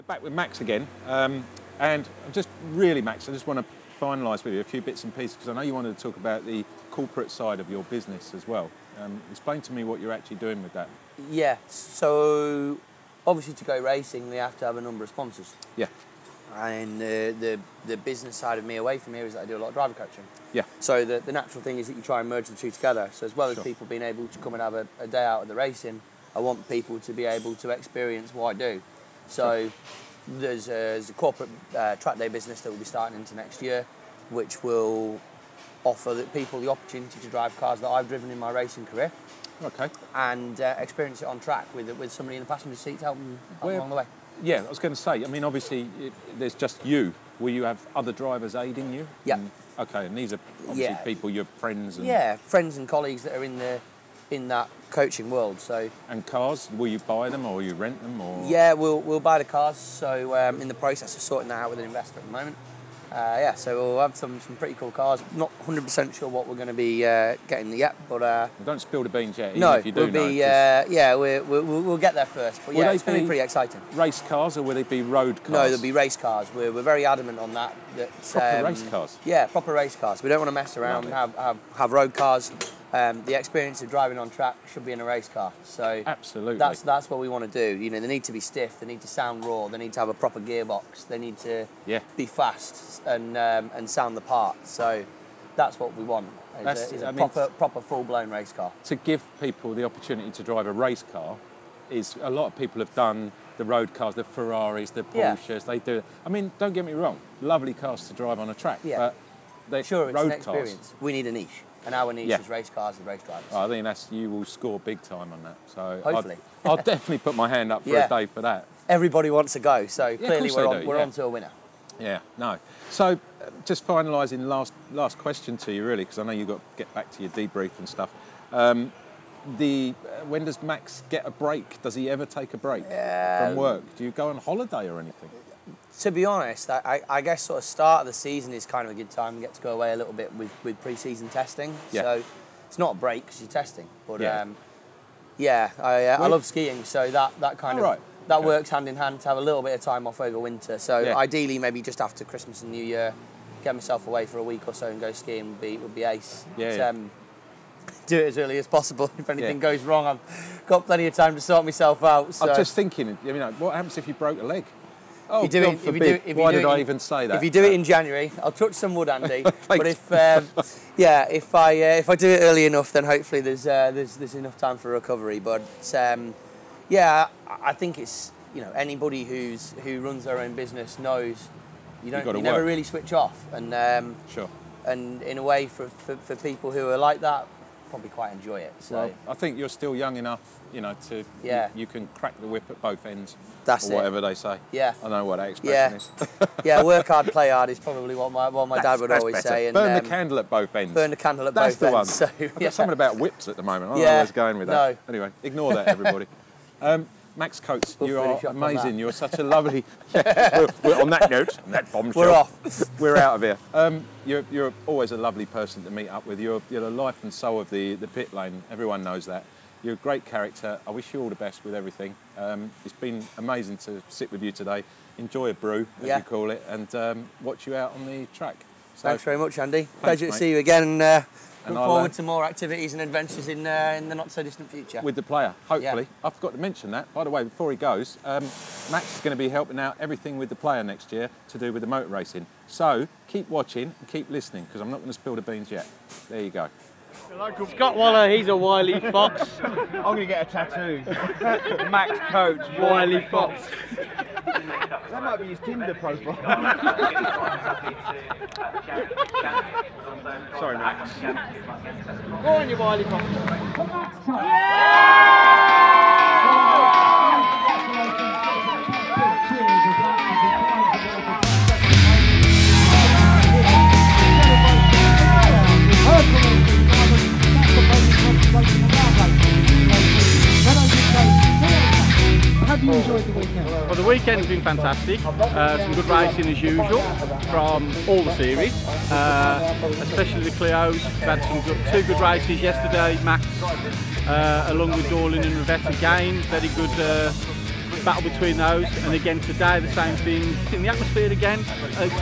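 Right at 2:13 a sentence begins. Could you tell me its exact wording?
Do you go on holiday or anything?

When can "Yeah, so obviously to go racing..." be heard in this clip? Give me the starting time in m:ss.
0:11.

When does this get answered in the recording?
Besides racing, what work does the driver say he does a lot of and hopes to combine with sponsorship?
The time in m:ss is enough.
0:19.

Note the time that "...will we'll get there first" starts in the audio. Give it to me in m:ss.
1:11.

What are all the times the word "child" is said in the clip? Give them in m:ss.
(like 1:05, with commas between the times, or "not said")
not said.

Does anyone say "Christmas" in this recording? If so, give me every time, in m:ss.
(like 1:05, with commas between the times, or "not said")
2:32.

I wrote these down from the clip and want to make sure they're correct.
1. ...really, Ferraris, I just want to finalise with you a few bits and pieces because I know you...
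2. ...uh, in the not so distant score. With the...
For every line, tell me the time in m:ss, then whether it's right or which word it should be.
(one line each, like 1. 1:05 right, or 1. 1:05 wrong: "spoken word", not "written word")
1. 0:02 wrong: "Max", not "Ferraris"
2. 3:53 wrong: "future", not "score".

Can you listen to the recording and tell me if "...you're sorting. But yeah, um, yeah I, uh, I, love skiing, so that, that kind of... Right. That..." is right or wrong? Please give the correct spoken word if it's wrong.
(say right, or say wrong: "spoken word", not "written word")
wrong: "testing", not "sorting".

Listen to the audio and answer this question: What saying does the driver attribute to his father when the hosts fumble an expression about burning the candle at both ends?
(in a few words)
Work hard, play hard.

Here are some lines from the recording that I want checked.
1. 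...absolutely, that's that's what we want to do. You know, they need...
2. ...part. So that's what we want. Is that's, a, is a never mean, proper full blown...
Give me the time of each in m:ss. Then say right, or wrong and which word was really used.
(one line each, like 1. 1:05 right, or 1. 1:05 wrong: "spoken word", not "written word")
1. 1:26 right
2. 1:34 wrong: "proper", not "never".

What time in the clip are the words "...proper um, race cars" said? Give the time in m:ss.
1:18.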